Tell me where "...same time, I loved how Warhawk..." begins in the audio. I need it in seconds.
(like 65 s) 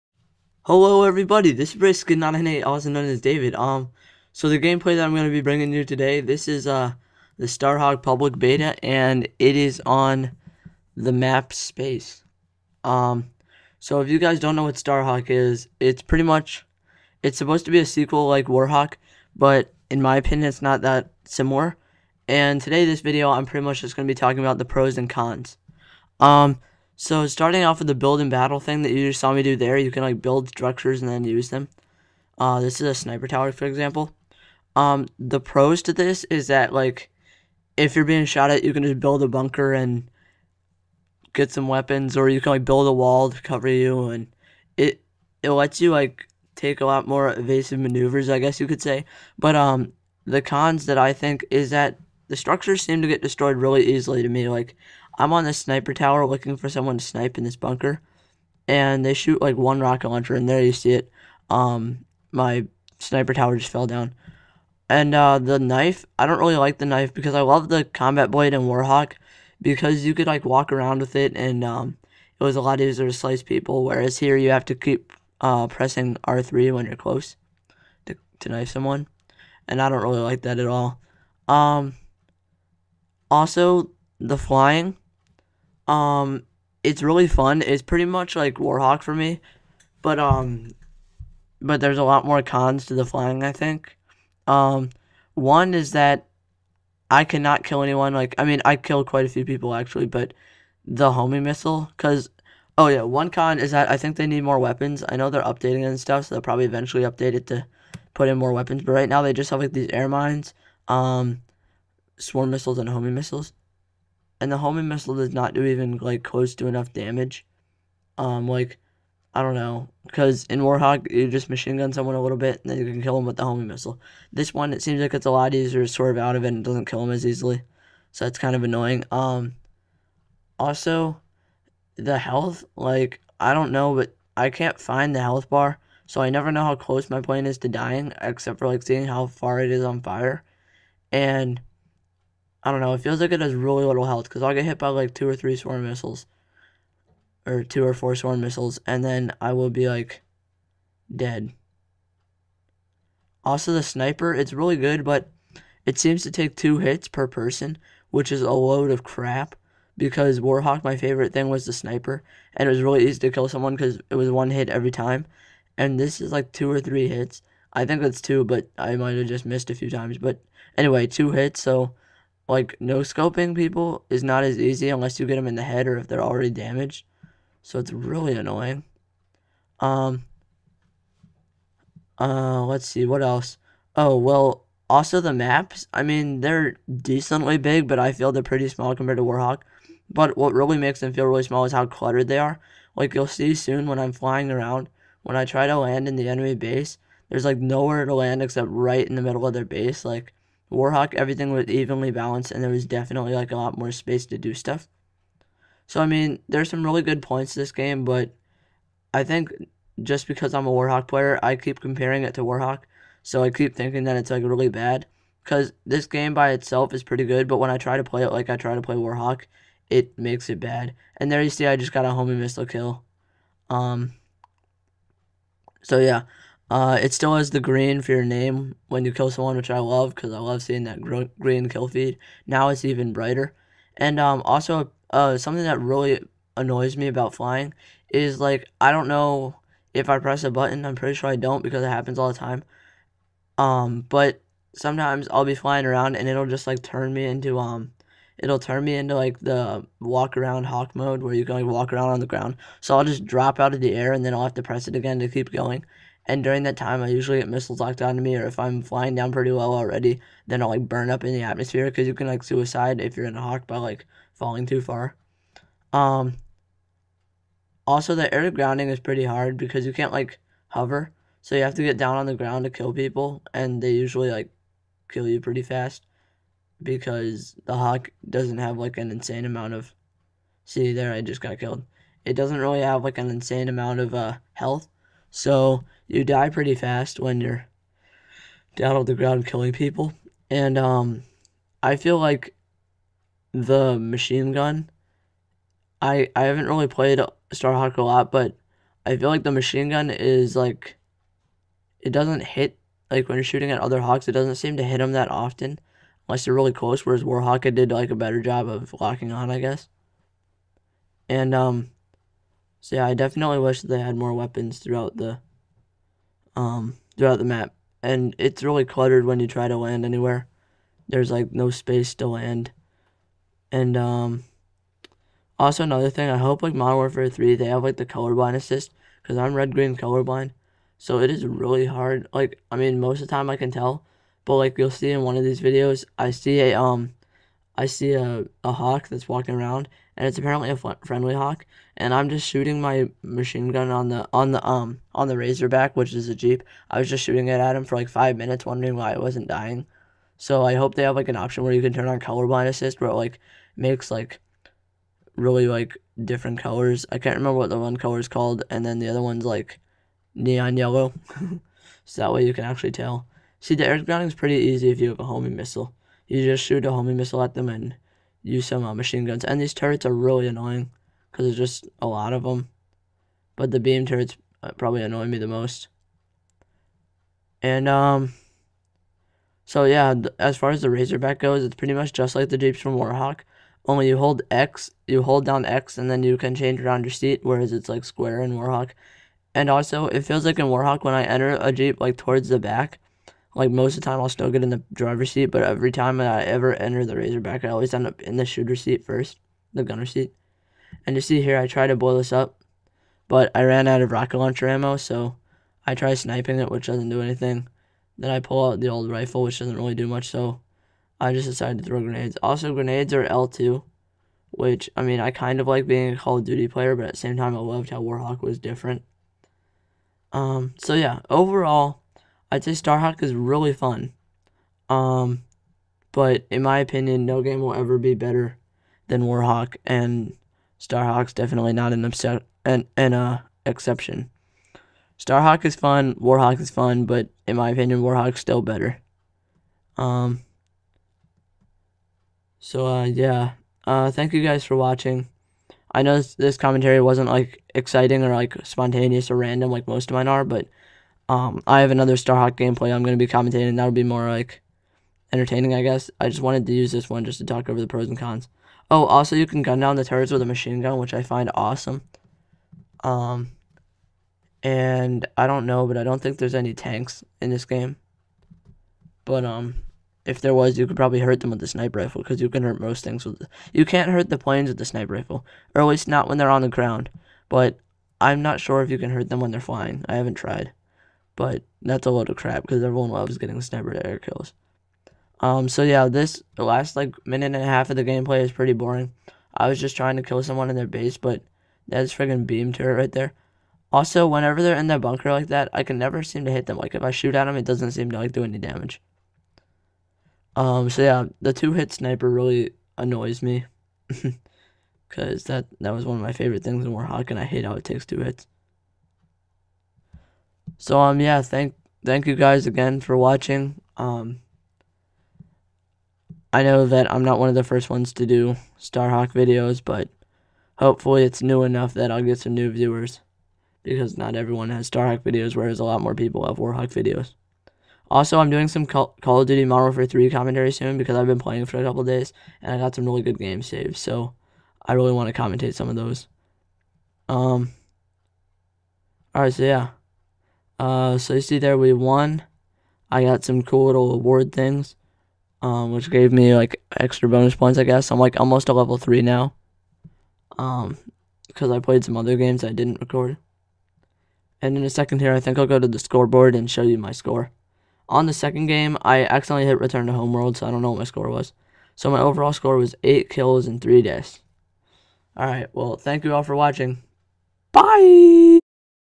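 417 s.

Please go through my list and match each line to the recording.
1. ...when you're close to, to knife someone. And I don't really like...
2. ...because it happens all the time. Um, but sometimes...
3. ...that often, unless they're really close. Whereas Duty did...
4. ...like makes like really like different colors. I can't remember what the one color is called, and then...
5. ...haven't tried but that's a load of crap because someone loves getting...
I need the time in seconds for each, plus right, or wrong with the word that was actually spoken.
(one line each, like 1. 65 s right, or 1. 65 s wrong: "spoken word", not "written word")
1. 76 s right
2. 241 s right
3. 305 s wrong: "Warhawk", not "Duty"
4. 353 s right
5. 480 s wrong: "everyone", not "someone".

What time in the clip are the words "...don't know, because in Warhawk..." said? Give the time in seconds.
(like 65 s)
119 s.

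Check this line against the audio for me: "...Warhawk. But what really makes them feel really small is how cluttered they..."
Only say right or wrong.
right.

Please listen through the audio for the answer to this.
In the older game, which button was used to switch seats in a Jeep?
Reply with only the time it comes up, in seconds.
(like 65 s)
388 s.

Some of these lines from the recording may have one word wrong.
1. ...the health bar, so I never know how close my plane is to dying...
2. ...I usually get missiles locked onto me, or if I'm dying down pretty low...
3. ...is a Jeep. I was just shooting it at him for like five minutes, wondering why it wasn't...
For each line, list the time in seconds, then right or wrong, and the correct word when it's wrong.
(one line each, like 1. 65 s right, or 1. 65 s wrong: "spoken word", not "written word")
1. 135 s right
2. 257 s wrong: "flying", not "dying"
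3. 346 s right.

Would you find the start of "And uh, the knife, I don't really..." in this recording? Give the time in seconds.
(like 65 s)
64 s.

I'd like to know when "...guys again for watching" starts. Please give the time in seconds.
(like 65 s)
512 s.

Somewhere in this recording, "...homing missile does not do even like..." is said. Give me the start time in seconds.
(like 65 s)
114 s.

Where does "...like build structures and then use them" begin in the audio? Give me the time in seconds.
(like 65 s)
30 s.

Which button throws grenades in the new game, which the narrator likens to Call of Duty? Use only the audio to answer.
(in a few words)
L2.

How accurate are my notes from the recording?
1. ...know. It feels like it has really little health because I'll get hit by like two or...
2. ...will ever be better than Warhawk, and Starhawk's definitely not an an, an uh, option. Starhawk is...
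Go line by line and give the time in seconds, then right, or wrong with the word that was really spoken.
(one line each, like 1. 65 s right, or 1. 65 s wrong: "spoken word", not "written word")
1. 142 s right
2. 427 s wrong: "exception", not "option".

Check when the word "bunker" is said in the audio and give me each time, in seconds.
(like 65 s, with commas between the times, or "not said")
39 s, 57 s, 494 s.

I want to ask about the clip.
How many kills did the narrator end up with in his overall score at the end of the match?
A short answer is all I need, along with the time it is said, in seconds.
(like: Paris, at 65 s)
8, at 563 s.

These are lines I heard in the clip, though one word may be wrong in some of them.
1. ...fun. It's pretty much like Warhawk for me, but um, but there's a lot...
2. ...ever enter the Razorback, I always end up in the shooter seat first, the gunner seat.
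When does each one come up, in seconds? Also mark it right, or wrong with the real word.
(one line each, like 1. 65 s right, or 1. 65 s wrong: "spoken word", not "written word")
1. 87 s right
2. 396 s right.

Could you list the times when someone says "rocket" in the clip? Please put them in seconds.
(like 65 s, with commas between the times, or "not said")
59 s, 404 s.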